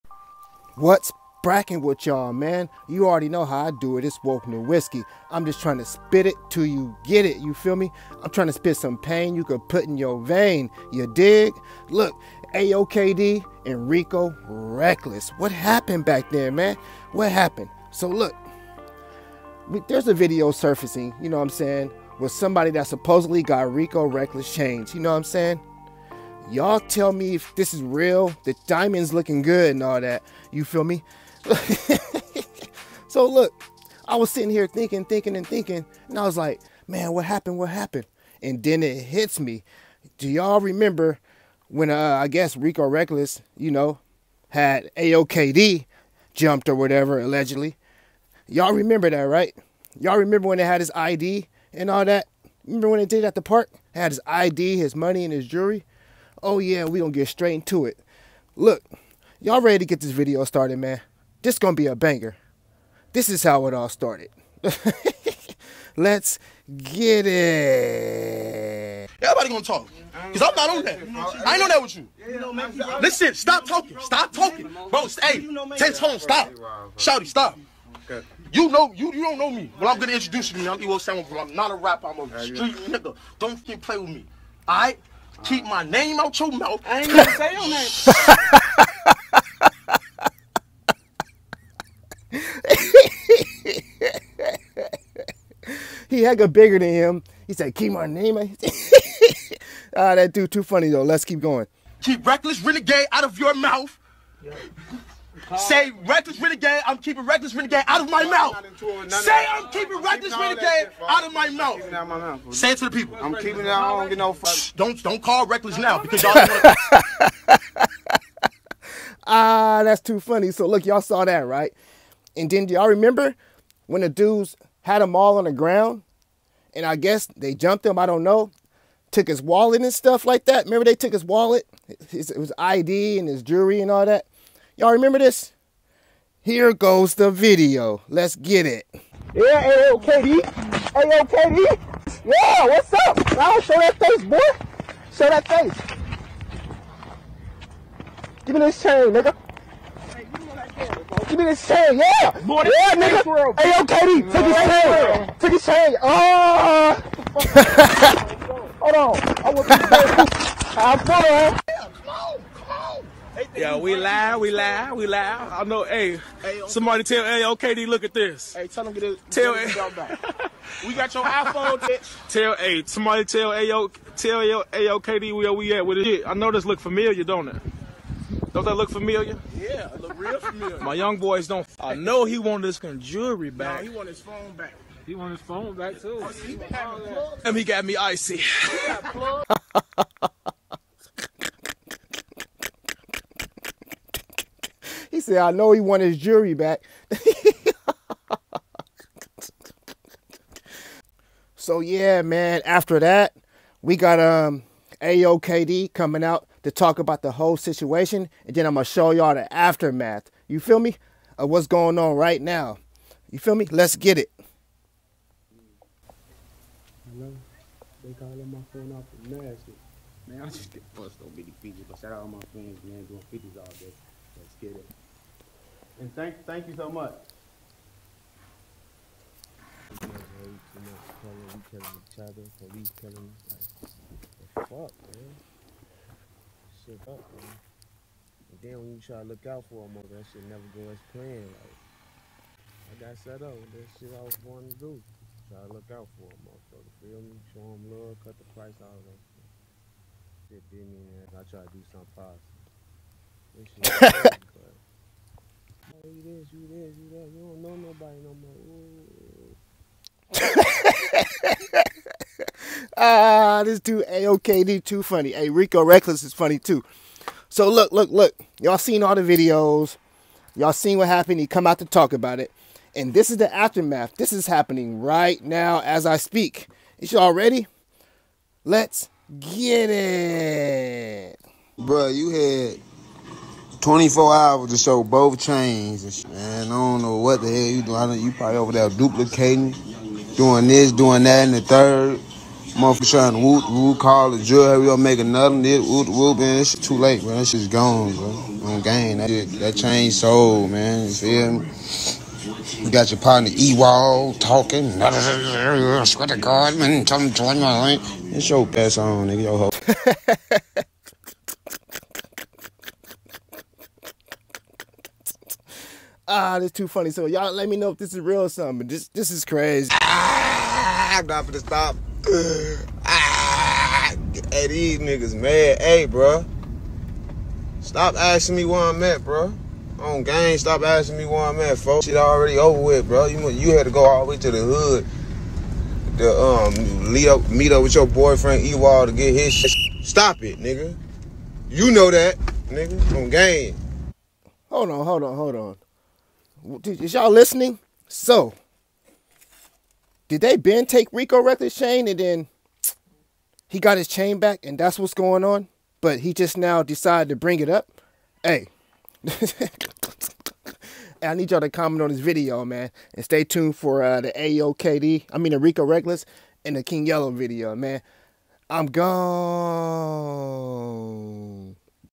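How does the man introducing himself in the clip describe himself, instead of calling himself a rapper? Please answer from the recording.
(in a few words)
A street nigga.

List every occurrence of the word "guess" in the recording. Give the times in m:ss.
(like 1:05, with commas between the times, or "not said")
0:42, 2:06.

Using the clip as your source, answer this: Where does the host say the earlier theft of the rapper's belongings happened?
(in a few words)
At the park.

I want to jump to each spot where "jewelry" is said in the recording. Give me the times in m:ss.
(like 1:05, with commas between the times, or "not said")
0:55, 2:13, 3:02.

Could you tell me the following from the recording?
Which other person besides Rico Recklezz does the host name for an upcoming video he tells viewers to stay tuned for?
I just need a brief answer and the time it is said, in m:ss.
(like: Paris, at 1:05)
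King Yella, at 6:06.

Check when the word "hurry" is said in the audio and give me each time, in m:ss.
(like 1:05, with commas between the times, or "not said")
4:54.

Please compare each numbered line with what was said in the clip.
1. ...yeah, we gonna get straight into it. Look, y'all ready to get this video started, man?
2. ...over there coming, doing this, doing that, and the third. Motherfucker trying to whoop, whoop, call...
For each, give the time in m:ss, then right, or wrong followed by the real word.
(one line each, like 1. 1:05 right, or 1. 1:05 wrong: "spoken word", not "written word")
1. 0:56 right
2. 4:48 wrong: "duplicating", not "coming".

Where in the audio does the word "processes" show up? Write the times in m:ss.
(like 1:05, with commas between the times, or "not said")
not said.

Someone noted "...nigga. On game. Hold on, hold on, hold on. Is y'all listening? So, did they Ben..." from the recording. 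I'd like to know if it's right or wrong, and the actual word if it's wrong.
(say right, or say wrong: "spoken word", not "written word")
right.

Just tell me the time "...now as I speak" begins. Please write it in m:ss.
4:35.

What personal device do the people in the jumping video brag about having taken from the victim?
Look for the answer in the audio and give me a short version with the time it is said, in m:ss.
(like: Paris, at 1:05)
iPhone, at 2:51.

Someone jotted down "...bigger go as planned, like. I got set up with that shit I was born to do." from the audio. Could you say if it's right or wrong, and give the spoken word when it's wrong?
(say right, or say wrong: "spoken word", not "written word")
wrong: "never", not "bigger".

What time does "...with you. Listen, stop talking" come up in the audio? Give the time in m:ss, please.
1:11.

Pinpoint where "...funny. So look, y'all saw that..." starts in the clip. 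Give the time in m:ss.
2:00.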